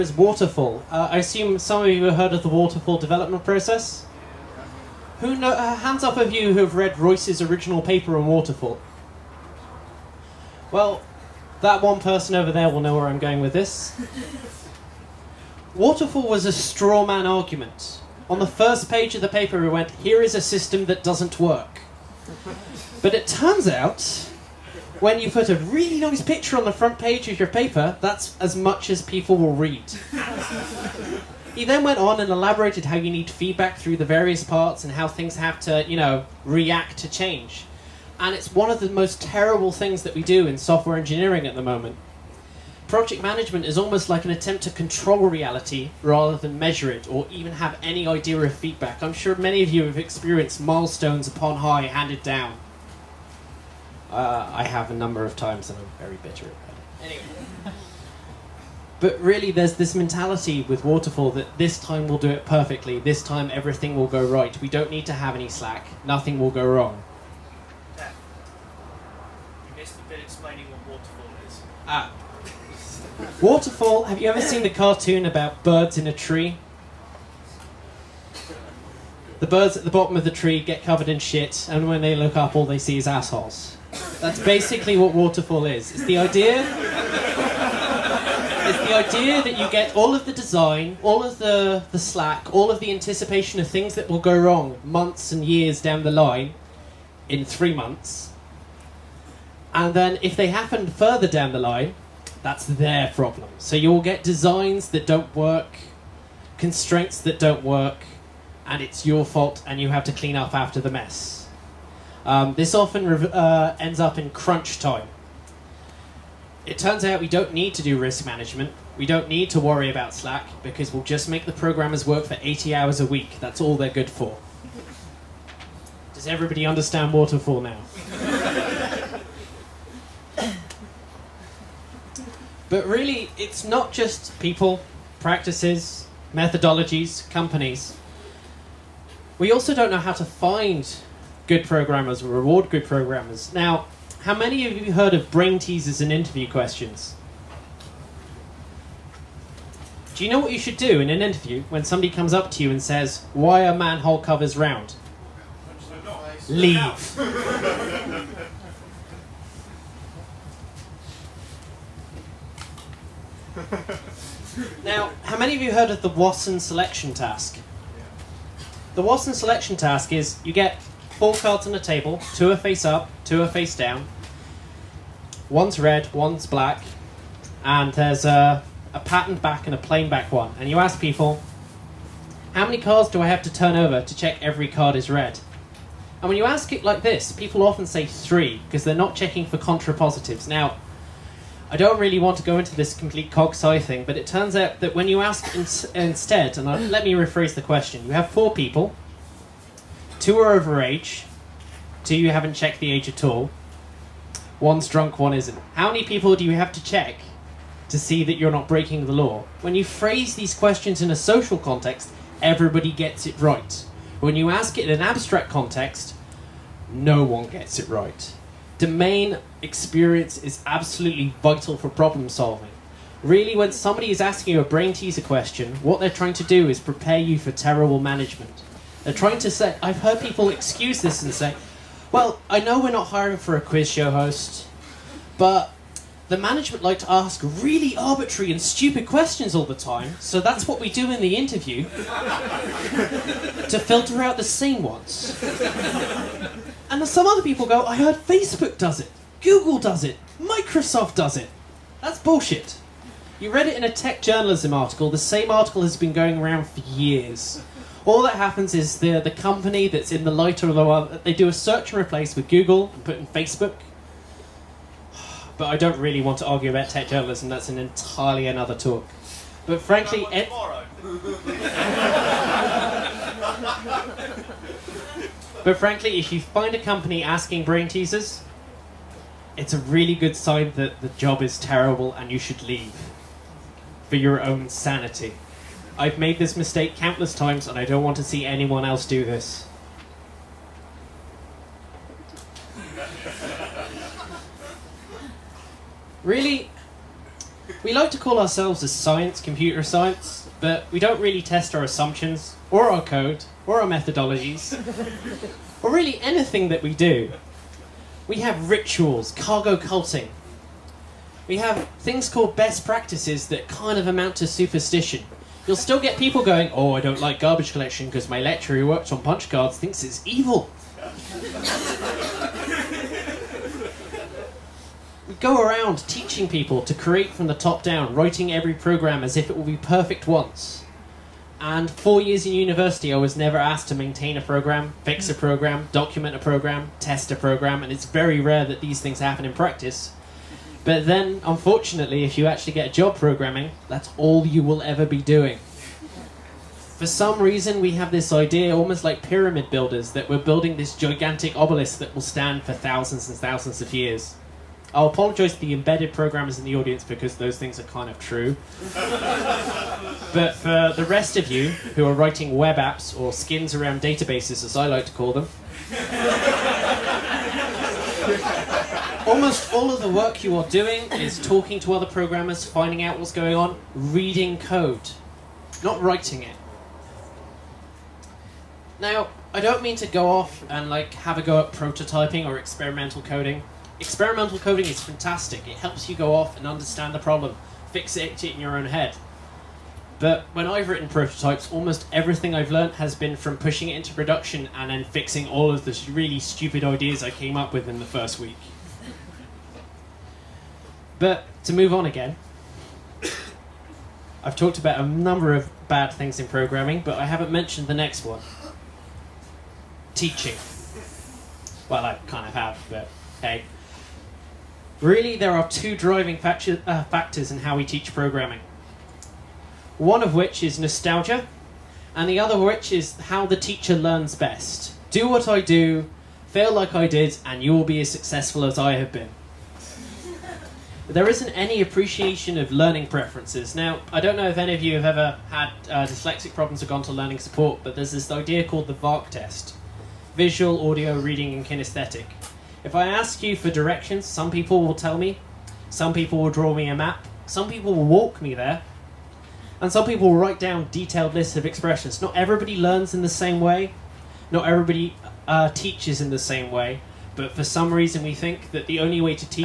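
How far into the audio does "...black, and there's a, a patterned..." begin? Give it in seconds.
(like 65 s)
176 s.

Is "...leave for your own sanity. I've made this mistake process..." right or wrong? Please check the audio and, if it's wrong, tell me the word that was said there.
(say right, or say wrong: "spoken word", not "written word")
wrong: "countless", not "process".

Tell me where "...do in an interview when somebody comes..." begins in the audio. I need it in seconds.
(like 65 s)
150 s.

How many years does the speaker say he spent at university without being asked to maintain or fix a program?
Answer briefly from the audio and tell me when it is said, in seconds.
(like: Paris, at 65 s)
4, at 331 s.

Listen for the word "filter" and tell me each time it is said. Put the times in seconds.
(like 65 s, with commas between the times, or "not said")
243 s.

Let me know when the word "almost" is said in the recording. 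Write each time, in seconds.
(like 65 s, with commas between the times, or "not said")
43 s, 348 s, 369 s, 391 s.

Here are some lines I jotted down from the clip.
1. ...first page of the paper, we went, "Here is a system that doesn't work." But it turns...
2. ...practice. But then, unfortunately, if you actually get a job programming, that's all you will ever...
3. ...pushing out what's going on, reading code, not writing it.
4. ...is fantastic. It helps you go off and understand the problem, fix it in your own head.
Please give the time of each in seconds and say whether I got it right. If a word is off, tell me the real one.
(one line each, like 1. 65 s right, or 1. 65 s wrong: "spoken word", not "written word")
1. 18 s right
2. 339 s right
3. 372 s wrong: "finding", not "pushing"
4. 384 s right.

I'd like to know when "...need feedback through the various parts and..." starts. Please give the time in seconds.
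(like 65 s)
33 s.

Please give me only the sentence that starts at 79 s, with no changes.
The birds at the bottom of the tree get covered in shit, and when they look up, all they see is assholes.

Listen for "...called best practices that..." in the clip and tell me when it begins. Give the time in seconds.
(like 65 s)
312 s.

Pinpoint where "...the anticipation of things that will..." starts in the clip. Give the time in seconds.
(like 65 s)
92 s.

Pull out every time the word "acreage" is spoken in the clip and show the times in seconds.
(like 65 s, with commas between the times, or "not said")
not said.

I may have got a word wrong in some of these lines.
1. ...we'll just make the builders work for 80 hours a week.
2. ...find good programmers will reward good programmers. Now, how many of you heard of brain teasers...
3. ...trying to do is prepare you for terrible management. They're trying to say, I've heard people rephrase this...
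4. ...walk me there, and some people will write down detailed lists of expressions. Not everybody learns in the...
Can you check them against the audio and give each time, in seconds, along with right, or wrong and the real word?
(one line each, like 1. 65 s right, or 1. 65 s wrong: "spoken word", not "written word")
1. 120 s wrong: "programmers", not "builders"
2. 140 s right
3. 226 s wrong: "excuse", not "rephrase"
4. 448 s right.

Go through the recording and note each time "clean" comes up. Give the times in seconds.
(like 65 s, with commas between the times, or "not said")
110 s.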